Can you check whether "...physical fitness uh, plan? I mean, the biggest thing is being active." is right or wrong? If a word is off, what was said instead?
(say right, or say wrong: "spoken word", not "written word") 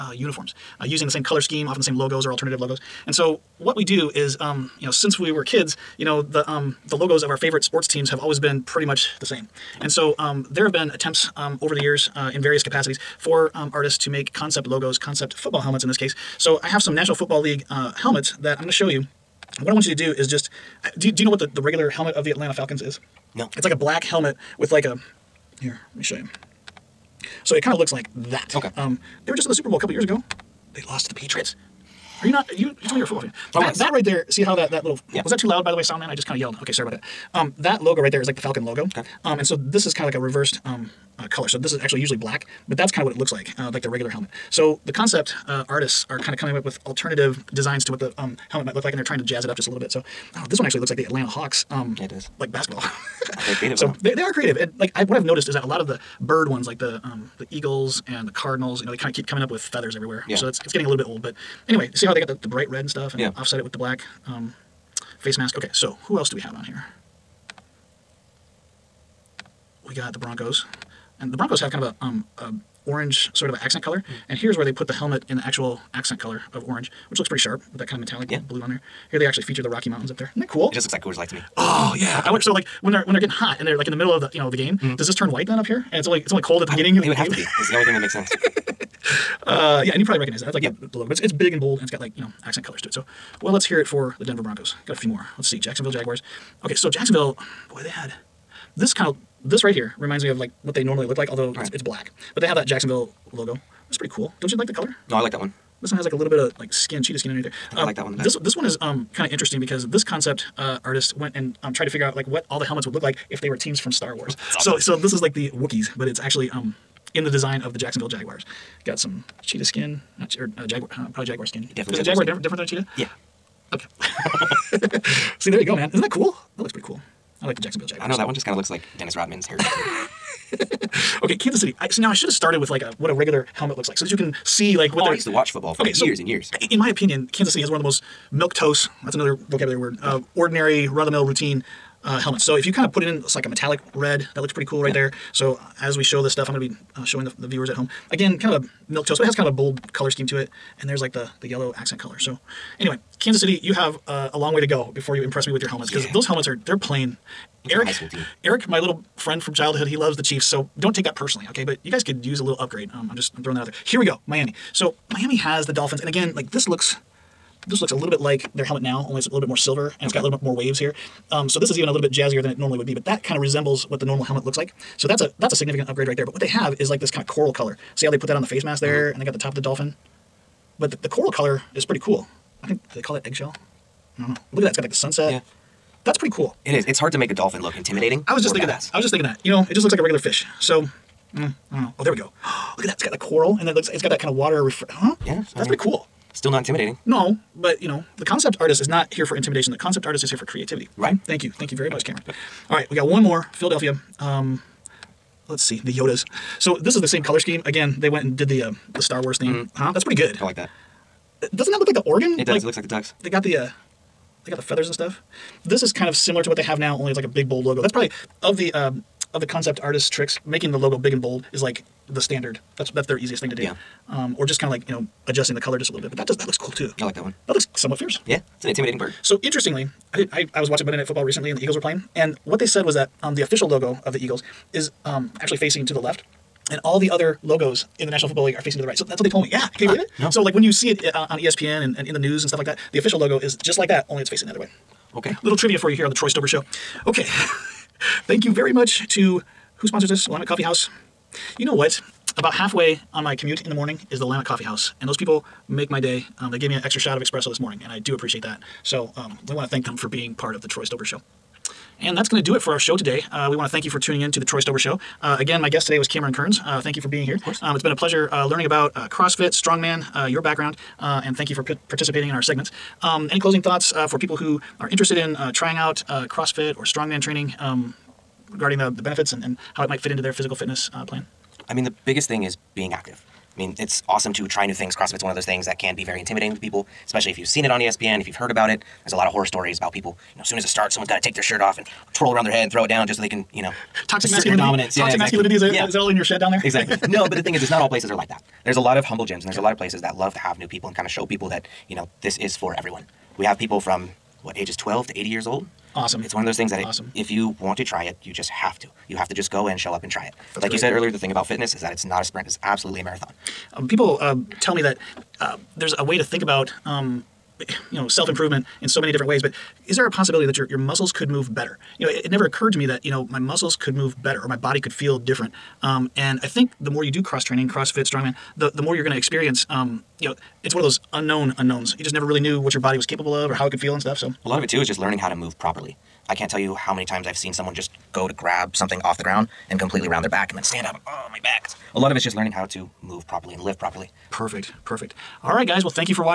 right.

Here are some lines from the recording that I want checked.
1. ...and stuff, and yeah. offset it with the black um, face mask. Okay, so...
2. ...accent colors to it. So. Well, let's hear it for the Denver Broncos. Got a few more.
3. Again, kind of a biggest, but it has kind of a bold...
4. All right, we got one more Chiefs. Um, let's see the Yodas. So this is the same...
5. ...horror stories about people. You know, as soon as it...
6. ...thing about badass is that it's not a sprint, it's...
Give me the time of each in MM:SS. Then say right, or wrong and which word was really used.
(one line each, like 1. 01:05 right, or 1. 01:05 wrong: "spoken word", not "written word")
1. 01:02 right
2. 01:32 right
3. 02:28 wrong: "milquetoast", not "biggest"
4. 03:22 wrong: "Philadelphia", not "Chiefs"
5. 04:49 right
6. 05:11 wrong: "fitness", not "badass".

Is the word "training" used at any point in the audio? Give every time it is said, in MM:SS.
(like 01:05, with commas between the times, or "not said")
04:37, 05:27.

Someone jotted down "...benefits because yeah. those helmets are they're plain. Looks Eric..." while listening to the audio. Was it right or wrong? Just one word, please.
wrong.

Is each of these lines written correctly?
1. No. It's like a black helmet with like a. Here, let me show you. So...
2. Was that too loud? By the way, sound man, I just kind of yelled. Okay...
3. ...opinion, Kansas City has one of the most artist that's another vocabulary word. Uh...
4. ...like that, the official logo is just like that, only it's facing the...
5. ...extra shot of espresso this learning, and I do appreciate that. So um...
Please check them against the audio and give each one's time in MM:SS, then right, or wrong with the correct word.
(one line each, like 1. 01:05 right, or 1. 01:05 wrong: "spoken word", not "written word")
1. 00:23 right
2. 00:35 right
3. 02:16 wrong: "milquetoast", not "artist"
4. 04:02 right
5. 04:16 wrong: "morning", not "learning".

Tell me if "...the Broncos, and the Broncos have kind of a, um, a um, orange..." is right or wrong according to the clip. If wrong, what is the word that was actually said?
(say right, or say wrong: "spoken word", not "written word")
right.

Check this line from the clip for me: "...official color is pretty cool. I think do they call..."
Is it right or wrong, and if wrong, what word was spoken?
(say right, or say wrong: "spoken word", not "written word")
wrong: "coral", not "official".